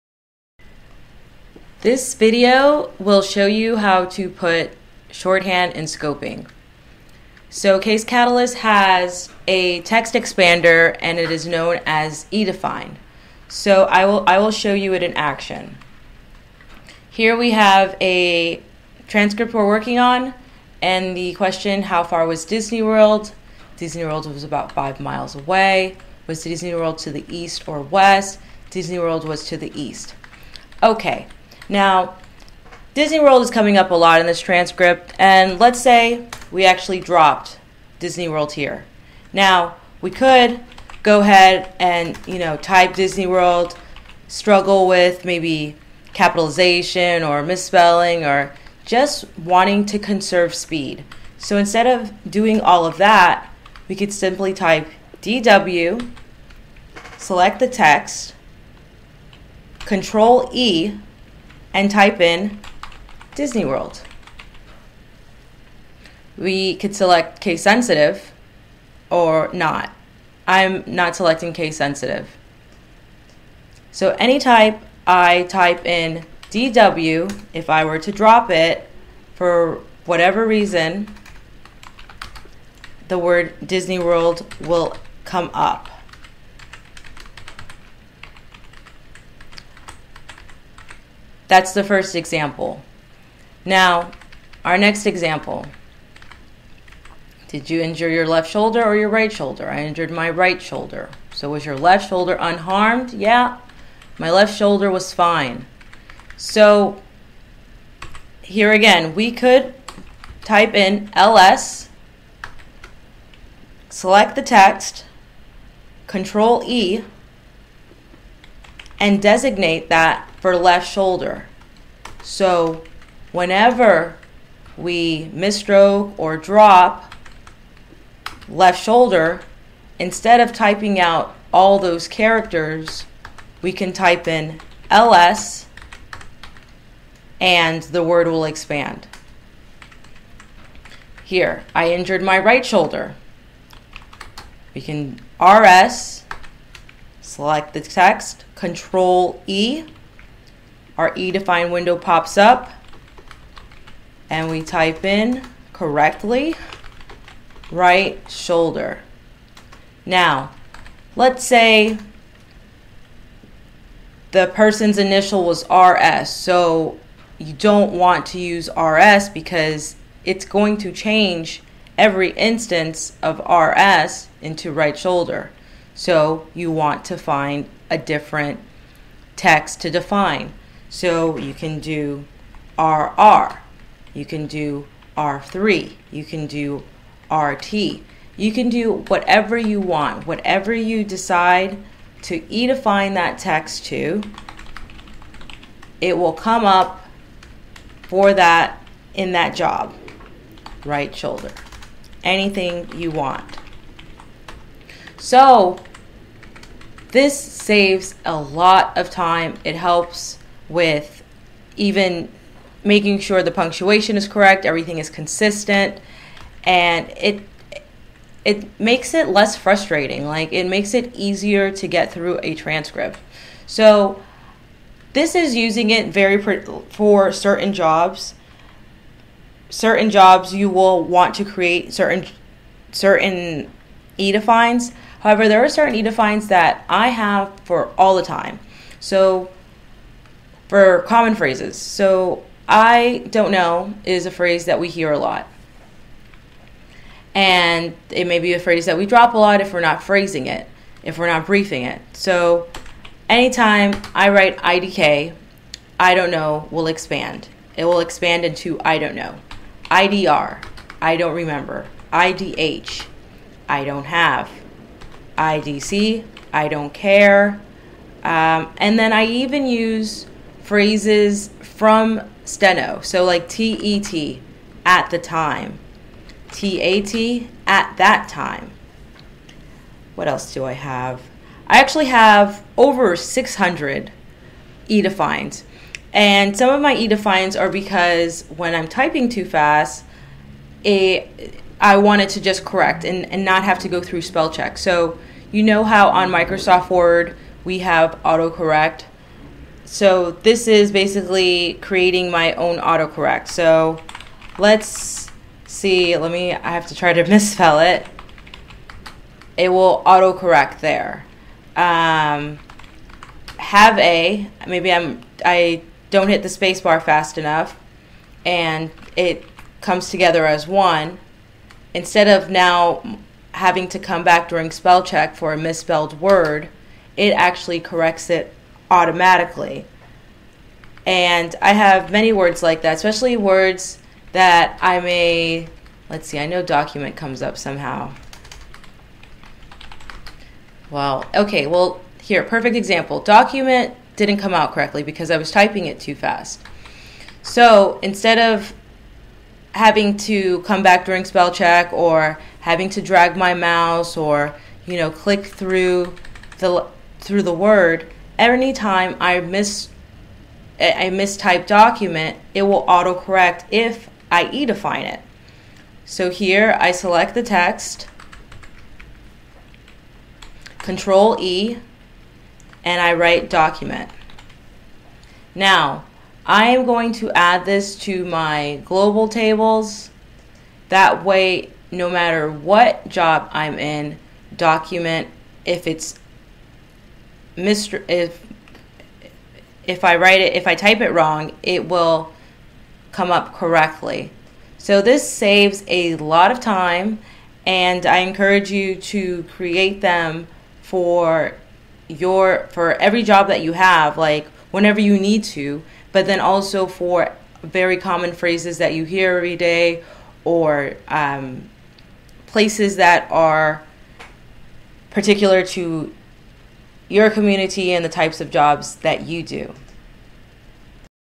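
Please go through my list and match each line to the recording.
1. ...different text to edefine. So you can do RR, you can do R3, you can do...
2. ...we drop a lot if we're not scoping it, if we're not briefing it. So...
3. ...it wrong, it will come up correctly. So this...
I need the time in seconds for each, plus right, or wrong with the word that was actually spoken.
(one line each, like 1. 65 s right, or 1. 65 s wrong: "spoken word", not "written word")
1. 177 s wrong: "define", not "edefine"
2. 248 s wrong: "phrasing", not "scoping"
3. 391 s right.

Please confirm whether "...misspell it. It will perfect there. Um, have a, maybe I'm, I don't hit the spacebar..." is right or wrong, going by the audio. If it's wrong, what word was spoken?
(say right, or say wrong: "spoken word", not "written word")
wrong: "autocorrect", not "perfect".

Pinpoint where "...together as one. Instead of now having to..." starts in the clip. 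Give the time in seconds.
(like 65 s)
320 s.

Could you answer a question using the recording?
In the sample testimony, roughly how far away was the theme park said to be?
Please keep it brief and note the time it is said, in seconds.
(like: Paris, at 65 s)
about five miles, at 24 s.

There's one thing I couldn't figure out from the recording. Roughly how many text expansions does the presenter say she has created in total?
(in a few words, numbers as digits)
over 600.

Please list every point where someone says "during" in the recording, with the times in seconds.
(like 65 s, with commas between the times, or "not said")
324 s, 351 s.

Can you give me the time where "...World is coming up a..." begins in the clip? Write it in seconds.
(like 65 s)
33 s.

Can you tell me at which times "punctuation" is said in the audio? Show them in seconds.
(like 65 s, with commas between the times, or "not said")
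213 s.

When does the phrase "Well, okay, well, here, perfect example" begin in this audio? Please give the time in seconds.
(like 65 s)
340 s.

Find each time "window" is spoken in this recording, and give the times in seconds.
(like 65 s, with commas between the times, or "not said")
151 s.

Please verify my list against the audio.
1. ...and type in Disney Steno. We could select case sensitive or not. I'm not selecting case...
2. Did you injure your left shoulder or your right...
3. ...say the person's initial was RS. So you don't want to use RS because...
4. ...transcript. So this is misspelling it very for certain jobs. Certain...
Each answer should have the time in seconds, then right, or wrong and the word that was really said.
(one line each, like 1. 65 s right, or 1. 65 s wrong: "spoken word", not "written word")
1. 61 s wrong: "World", not "Steno"
2. 97 s right
3. 161 s right
4. 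222 s wrong: "using", not "misspelling".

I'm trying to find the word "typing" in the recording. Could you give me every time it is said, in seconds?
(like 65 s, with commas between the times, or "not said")
130 s, 288 s, 345 s.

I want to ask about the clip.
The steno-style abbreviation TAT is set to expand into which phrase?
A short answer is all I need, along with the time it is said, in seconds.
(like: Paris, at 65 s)
at that time, at 277 s.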